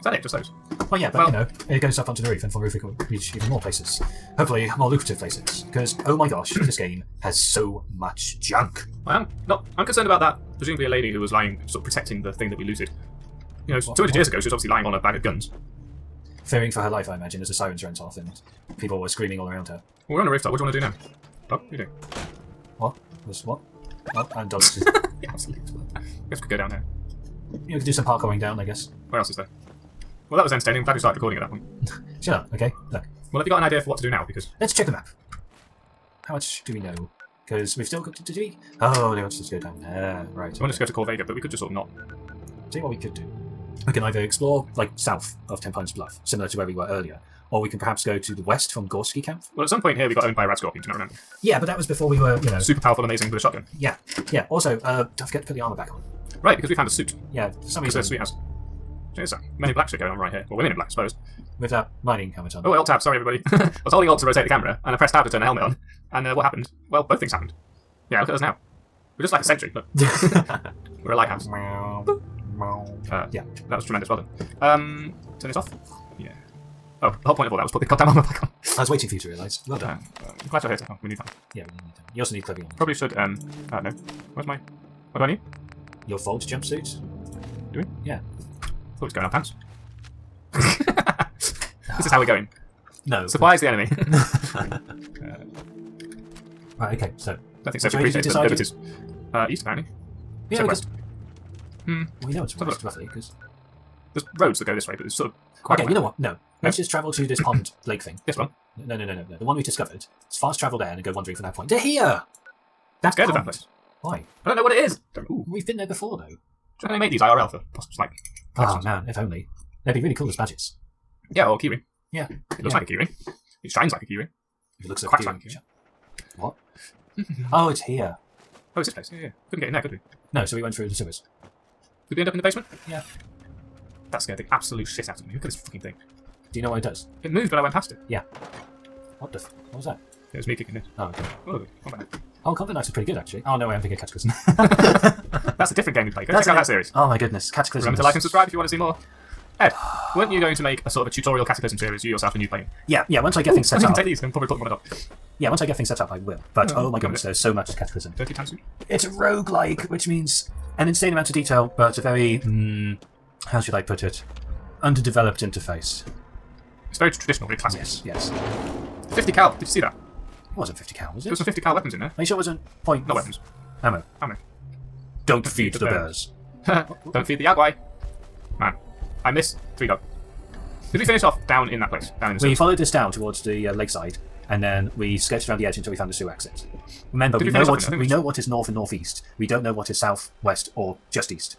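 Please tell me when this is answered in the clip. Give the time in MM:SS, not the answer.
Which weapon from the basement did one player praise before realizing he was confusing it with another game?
02:21.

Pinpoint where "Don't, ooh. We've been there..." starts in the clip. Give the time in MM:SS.
01:55.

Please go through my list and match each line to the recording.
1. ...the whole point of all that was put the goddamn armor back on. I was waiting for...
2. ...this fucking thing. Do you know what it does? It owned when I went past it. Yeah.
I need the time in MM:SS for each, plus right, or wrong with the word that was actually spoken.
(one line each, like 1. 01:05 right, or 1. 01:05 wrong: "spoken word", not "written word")
1. 01:17 right
2. 02:15 wrong: "moved", not "owned".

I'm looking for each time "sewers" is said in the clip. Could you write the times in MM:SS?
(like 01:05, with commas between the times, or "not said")
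02:10, 03:06.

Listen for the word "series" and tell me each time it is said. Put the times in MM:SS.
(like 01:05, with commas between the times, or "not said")
02:26, 02:31.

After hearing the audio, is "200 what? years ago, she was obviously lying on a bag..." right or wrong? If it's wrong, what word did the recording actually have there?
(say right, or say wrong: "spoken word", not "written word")
right.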